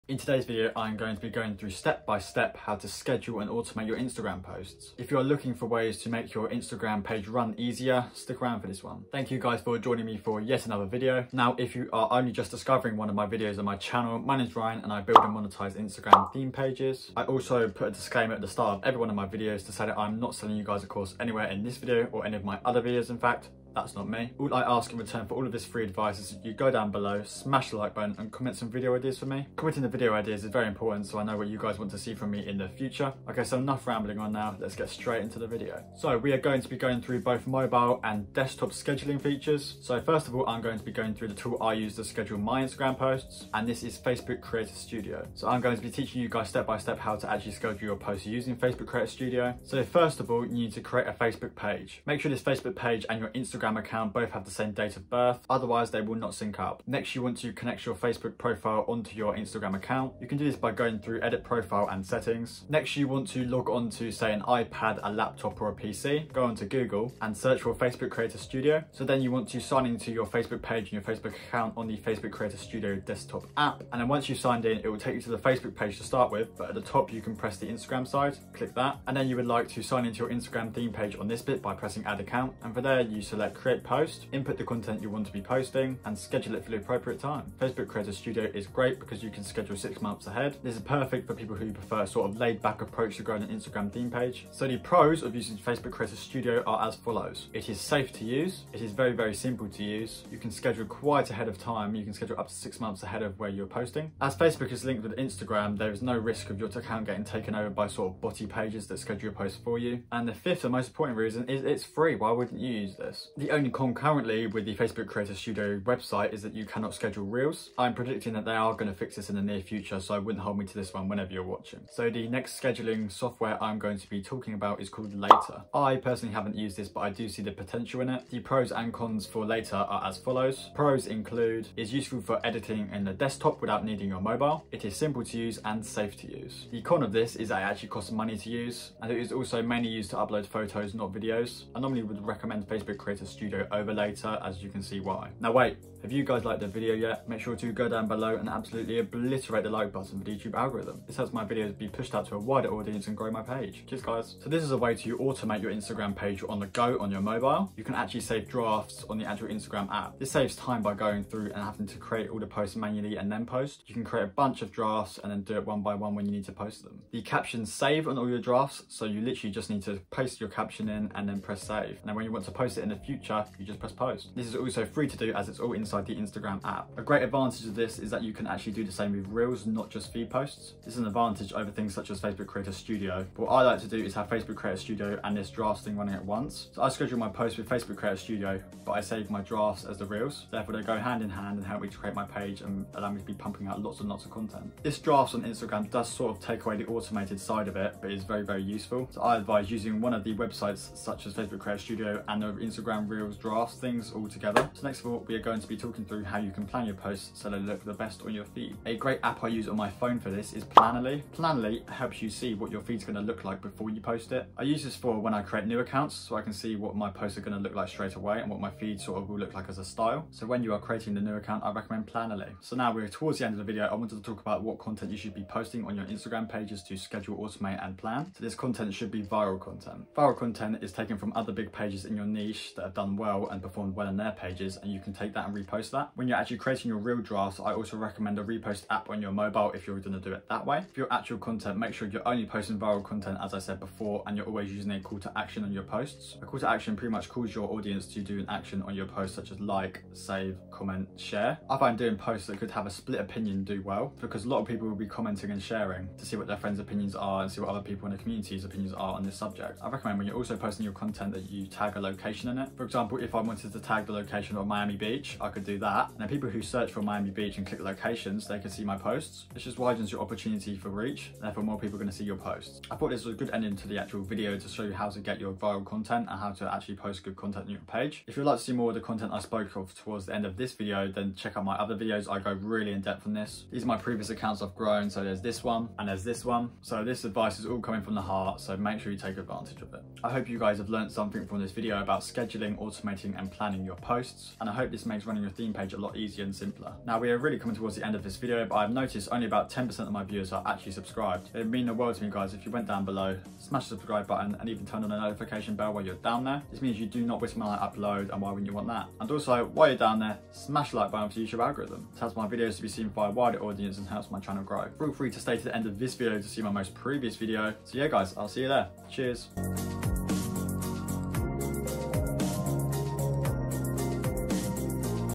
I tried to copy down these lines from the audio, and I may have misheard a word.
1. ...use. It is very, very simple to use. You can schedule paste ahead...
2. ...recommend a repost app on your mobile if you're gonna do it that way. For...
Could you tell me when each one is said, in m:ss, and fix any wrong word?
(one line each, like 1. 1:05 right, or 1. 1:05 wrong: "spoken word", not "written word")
1. 1:38 wrong: "quite", not "paste"
2. 3:57 right.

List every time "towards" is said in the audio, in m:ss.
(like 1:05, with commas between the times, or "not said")
3:43, 4:39, 4:57.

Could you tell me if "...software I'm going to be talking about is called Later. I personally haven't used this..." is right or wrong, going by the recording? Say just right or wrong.
right.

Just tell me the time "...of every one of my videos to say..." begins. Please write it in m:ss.
0:18.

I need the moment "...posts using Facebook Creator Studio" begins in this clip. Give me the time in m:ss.
0:47.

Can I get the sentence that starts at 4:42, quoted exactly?
I go really in depth on this.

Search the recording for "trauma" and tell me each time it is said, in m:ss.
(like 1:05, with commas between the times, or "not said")
not said.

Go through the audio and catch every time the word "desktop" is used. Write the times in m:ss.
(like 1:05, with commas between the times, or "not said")
0:38, 1:12, 2:13.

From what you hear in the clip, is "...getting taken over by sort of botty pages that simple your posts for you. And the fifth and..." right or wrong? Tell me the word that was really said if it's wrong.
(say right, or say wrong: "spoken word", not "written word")
wrong: "schedule", not "simple".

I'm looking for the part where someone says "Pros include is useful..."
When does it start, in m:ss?
2:10.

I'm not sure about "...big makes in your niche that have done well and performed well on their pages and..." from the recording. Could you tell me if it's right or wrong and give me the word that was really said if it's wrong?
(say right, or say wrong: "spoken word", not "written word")
wrong: "pages", not "makes".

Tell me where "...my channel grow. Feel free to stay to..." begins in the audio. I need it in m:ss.
5:14.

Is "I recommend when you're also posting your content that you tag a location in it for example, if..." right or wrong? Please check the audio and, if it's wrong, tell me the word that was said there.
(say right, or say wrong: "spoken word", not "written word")
right.